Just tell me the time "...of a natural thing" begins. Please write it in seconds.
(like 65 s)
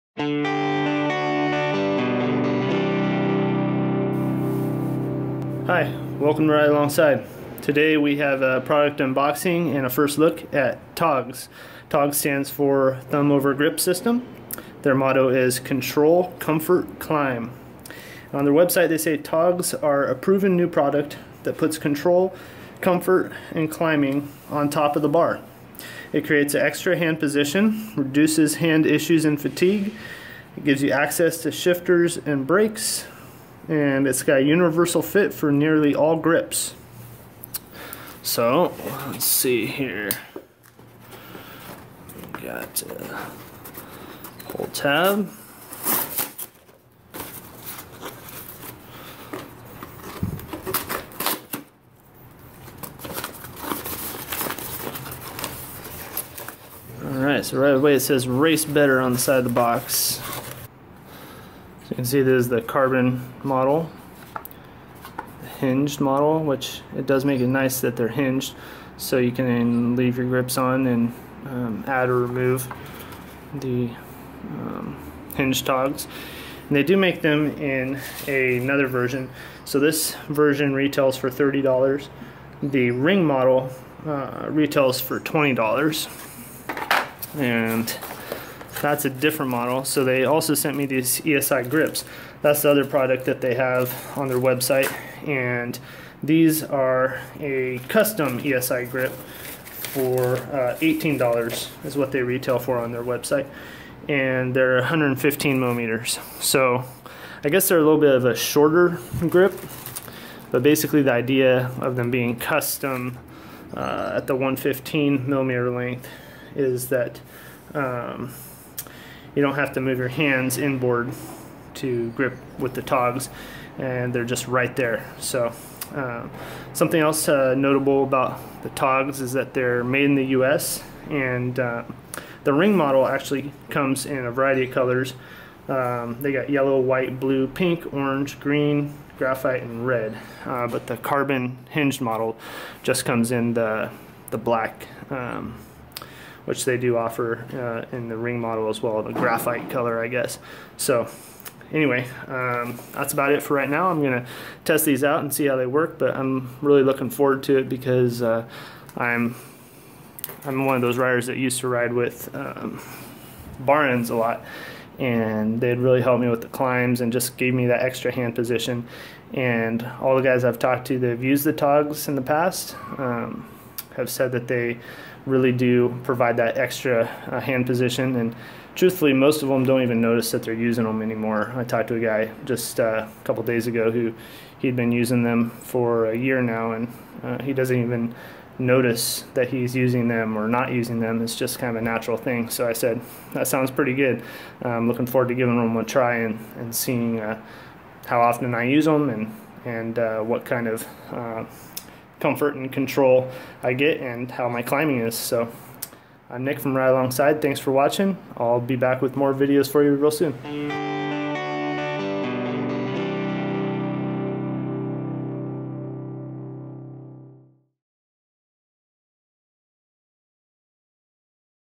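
191 s.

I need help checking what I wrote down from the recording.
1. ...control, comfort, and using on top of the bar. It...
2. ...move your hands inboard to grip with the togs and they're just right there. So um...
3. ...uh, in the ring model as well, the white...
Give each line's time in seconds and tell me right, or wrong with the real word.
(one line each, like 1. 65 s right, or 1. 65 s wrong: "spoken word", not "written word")
1. 21 s wrong: "climbing", not "using"
2. 119 s right
3. 147 s wrong: "graphite", not "white".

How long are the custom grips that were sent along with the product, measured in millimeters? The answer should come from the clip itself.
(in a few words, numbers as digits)
115 millimeters.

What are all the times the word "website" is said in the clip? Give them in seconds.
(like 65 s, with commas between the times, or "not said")
18 s, 94 s, 103 s.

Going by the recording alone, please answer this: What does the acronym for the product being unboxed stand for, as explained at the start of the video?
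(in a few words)
Thumb Over Grip System.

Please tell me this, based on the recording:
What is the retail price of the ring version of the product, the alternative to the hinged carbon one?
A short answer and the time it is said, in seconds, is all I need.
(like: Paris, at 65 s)
$20, at 85 s.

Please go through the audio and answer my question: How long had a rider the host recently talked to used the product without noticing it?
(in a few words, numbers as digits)
a year.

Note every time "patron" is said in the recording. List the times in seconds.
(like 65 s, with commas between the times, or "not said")
not said.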